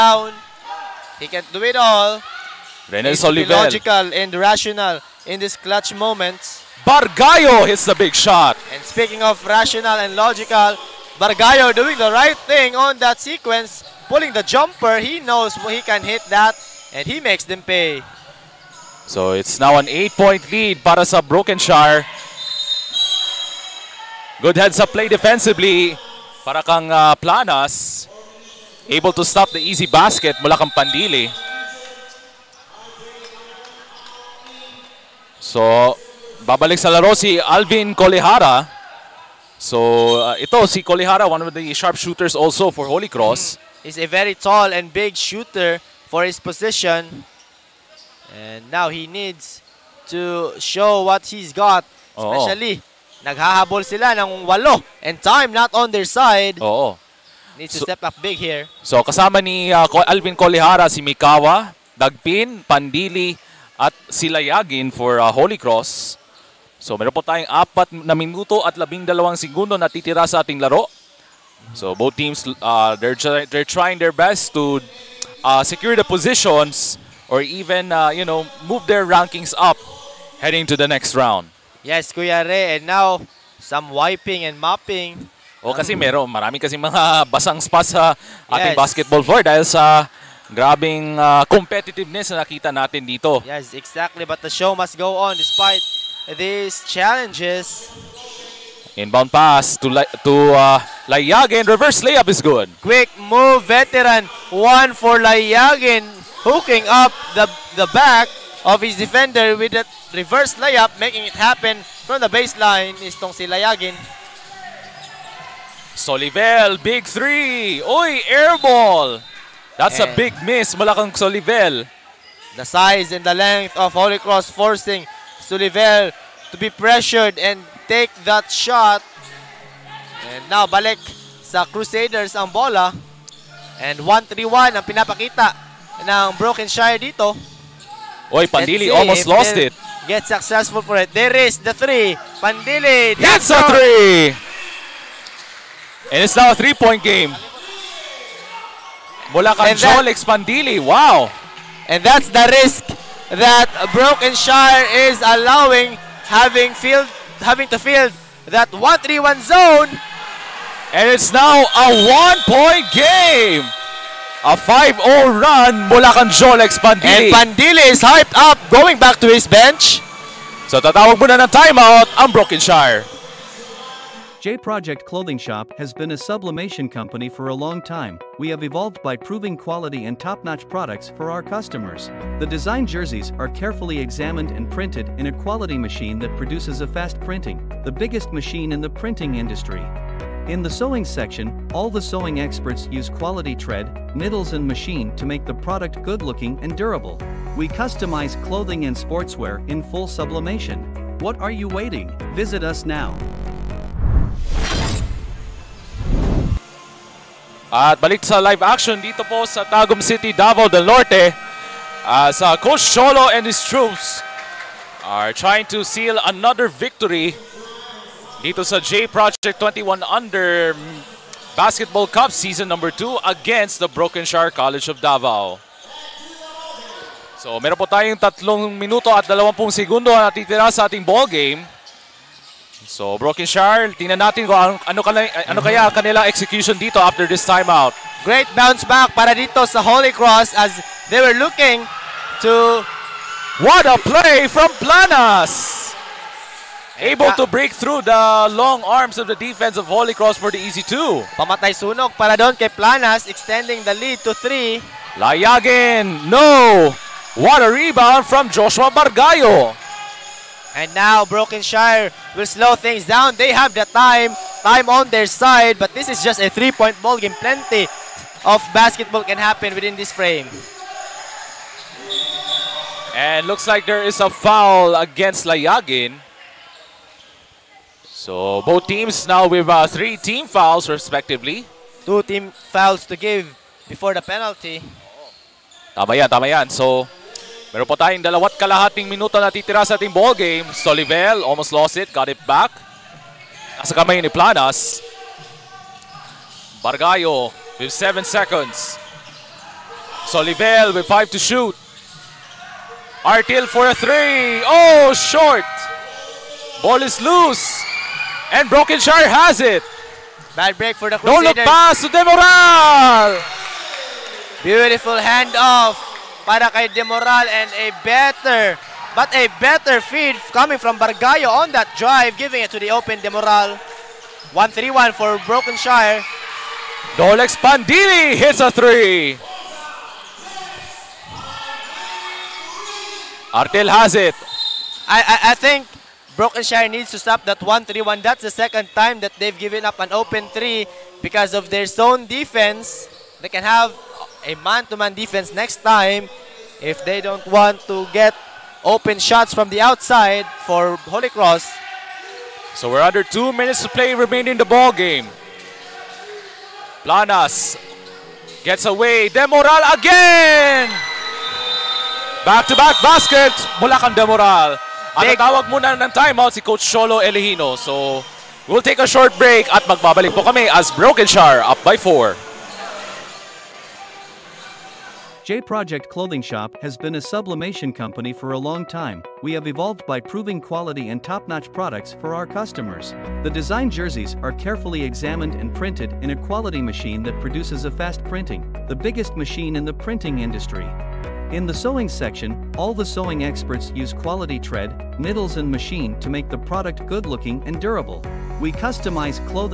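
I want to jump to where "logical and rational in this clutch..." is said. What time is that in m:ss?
0:03.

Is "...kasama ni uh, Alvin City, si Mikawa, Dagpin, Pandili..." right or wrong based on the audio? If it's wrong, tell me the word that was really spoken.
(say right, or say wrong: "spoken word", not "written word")
wrong: "Kolihara", not "City".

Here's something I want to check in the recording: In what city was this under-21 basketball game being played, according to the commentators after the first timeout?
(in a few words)
Tagum City.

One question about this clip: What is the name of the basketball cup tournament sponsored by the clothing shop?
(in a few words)
J Project 21 Under Basketball Cup.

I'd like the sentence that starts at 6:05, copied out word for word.
At tawag muna ng timeout si Coach Solo Elihino.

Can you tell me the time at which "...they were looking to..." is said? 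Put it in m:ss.
4:01.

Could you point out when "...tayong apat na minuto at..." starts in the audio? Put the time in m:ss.
1:07.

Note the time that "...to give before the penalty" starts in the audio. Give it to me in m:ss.
4:43.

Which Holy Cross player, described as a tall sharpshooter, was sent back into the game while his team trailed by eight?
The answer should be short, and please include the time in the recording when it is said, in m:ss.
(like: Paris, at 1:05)
Alvin Colihara, at 0:37.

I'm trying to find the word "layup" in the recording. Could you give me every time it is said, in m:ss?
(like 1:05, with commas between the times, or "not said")
1:42, 1:50.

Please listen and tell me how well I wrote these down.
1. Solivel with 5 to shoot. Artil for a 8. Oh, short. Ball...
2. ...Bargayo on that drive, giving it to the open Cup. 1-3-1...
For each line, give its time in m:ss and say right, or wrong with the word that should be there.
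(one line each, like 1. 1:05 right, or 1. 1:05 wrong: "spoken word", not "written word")
1. 5:00 wrong: "3", not "8"
2. 5:21 wrong: "Demoral", not "Cup".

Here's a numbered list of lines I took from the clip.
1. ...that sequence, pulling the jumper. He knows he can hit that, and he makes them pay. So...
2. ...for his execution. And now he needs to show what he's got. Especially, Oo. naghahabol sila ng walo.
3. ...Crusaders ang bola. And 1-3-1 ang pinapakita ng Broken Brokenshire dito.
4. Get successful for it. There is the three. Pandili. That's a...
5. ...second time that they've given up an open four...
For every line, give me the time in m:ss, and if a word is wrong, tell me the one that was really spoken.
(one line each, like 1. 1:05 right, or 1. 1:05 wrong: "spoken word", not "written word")
1. 0:12 right
2. 0:46 wrong: "position", not "execution"
3. 2:11 right
4. 2:20 right
5. 5:38 wrong: "three", not "four".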